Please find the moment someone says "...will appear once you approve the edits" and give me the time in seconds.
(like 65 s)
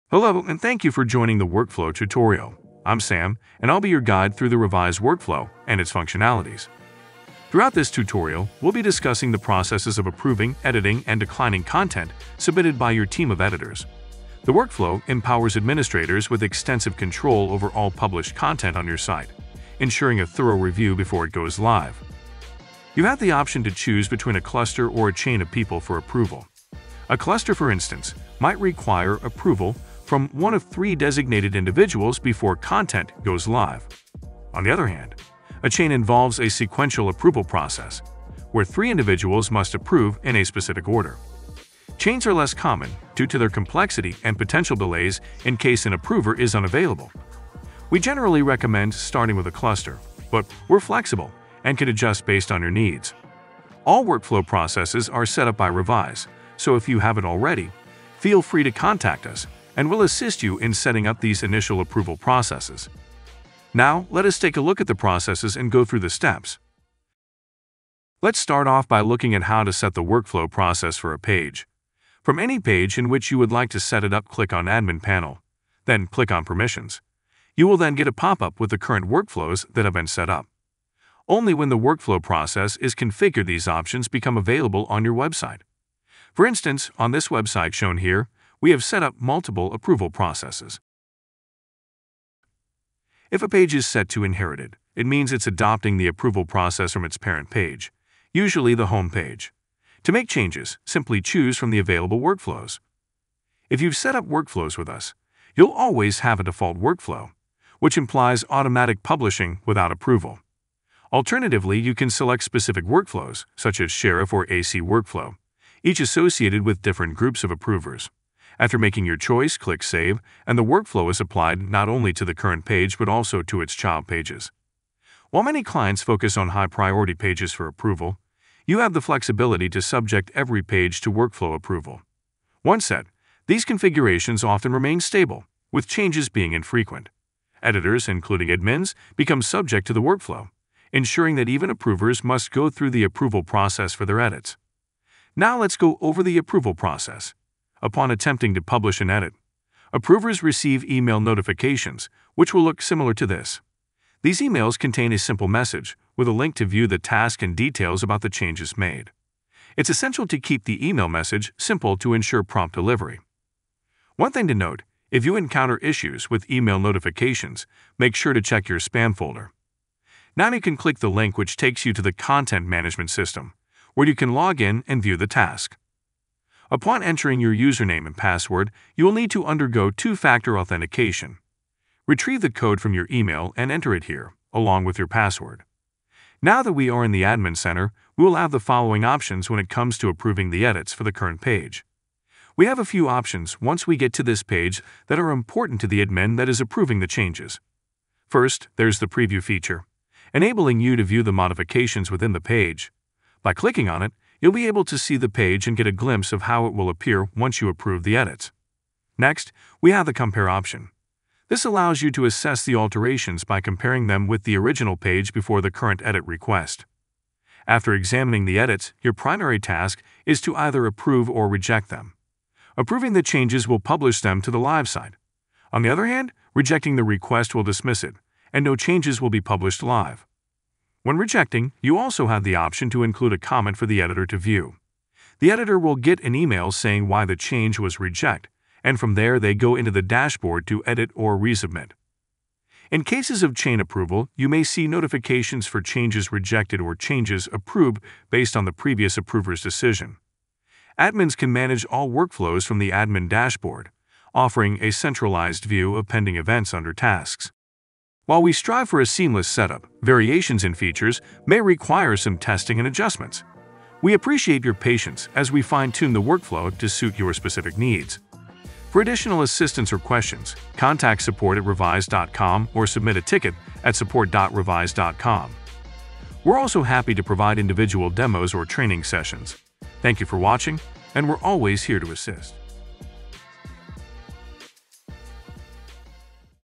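206 s.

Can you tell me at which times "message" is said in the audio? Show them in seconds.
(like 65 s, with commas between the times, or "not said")
155 s, 161 s.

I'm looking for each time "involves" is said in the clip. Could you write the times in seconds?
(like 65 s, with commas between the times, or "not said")
35 s.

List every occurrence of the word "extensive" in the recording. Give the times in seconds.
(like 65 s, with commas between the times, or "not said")
16 s.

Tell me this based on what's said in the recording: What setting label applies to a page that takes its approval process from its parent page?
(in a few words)
inherited.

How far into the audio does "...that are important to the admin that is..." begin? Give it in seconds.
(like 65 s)
195 s.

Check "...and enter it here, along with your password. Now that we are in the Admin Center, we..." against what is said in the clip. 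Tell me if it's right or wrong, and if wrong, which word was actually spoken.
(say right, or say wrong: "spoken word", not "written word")
right.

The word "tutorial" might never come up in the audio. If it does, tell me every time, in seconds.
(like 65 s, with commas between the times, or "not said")
1 s, 7 s.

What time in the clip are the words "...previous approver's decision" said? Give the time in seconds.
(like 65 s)
248 s.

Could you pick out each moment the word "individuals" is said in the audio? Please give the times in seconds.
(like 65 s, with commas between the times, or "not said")
31 s, 38 s, 277 s.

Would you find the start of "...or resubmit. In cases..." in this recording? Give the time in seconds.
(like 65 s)
241 s.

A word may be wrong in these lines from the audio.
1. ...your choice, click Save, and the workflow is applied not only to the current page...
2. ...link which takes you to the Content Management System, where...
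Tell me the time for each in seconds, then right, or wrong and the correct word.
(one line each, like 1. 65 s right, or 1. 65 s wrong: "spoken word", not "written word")
1. 119 s right
2. 171 s right.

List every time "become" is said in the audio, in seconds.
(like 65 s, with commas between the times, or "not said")
84 s, 139 s.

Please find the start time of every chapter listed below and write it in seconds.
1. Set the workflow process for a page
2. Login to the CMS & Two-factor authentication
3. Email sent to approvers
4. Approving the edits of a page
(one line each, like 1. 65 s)
1. 68 s
2. 171 s
3. 149 s
4. 185 s.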